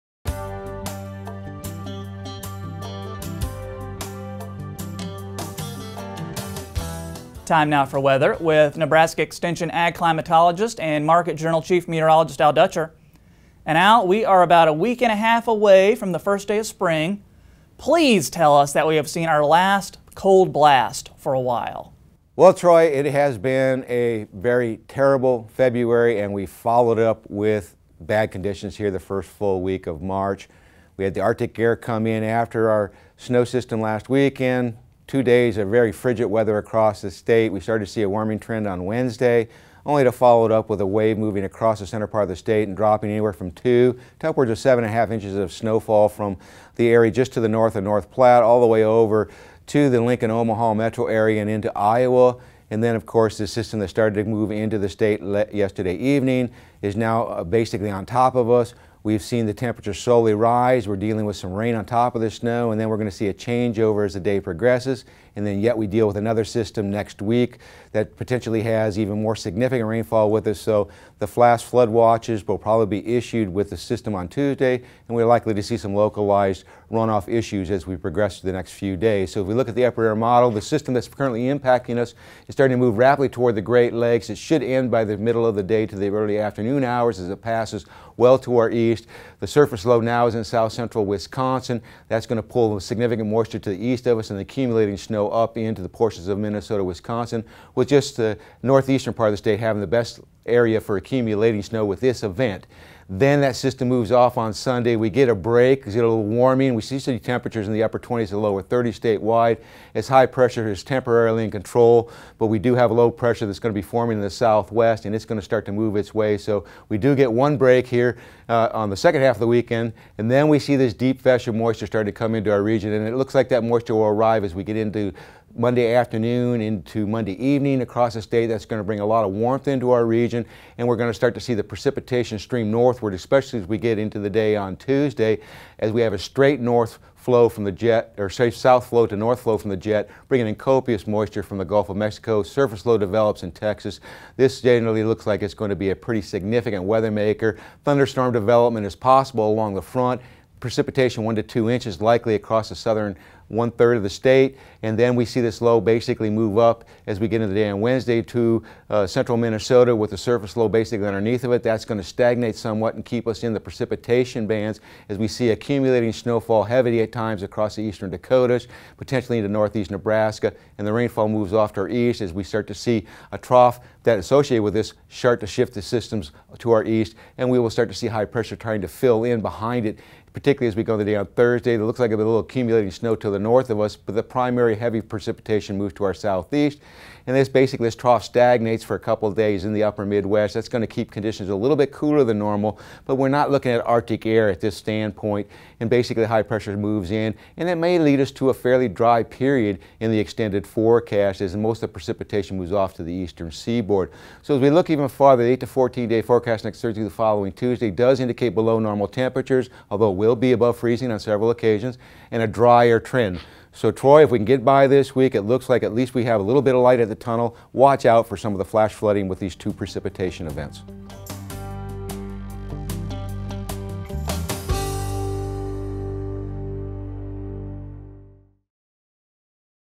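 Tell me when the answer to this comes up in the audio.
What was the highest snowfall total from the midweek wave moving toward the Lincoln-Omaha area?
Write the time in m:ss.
0:44.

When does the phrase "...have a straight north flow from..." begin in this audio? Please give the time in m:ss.
2:16.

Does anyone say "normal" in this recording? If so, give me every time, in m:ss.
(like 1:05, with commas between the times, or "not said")
3:12, 3:28.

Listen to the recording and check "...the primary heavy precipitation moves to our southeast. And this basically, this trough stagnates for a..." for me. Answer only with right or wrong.
right.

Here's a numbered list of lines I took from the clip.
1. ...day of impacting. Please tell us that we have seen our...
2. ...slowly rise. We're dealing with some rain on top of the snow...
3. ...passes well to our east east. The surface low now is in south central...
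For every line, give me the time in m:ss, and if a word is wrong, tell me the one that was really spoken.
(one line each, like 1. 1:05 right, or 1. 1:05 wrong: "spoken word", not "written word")
1. 0:16 wrong: "spring", not "impacting"
2. 0:59 right
3. 1:27 right.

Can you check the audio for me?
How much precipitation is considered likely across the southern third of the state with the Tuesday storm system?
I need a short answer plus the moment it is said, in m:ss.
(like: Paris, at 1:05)
1 to 2 inches, at 2:31.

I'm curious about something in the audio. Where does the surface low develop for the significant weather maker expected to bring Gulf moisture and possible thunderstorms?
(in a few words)
Texas.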